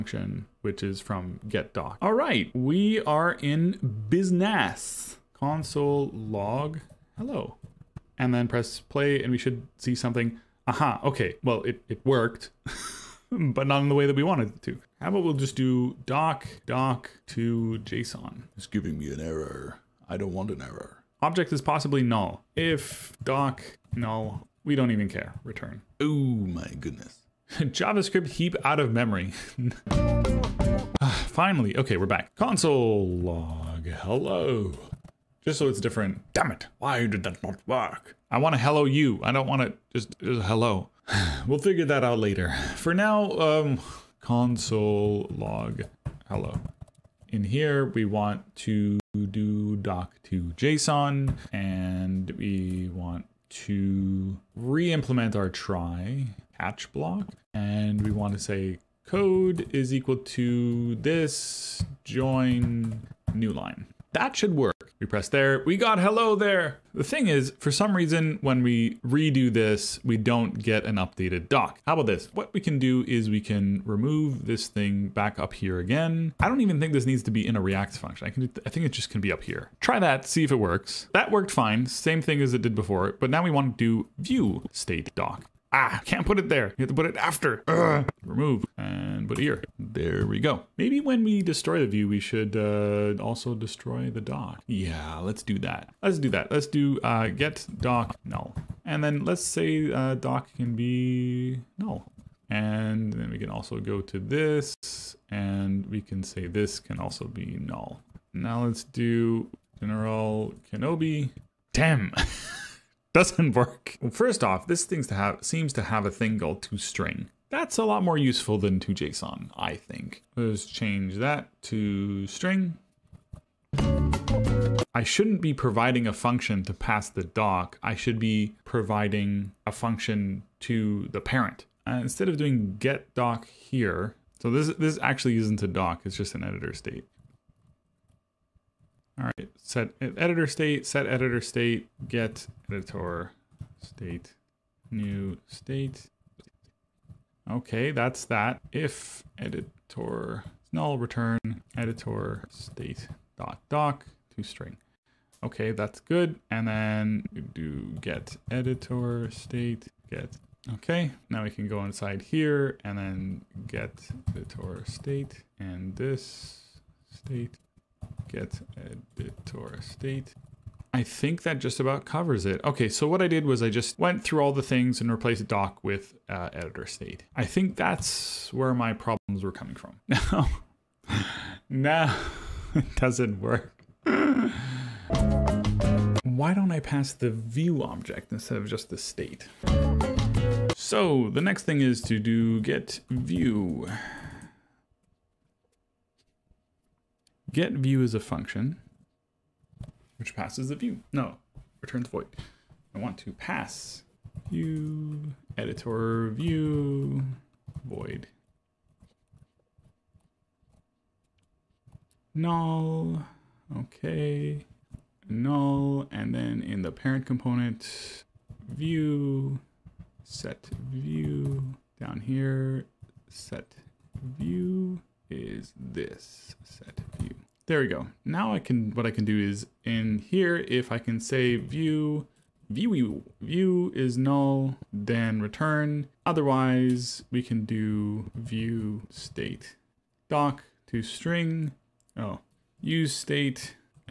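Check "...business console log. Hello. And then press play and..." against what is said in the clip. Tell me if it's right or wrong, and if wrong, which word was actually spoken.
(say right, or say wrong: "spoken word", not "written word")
right.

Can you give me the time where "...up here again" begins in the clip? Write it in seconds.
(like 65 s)
75 s.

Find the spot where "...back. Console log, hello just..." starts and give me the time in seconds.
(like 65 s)
32 s.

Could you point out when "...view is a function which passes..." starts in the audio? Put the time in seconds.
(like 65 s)
197 s.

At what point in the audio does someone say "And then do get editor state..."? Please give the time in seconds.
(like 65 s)
156 s.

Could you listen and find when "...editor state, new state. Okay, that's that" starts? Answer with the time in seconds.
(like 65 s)
142 s.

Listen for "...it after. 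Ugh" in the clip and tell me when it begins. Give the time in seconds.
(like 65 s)
87 s.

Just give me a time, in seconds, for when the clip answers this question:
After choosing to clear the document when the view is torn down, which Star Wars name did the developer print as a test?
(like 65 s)
109 s.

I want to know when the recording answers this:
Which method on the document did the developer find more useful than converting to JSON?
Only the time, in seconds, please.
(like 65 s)
116 s.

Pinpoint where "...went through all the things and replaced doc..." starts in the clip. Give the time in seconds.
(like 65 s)
173 s.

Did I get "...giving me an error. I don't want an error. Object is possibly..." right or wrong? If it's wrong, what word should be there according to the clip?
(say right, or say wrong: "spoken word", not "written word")
right.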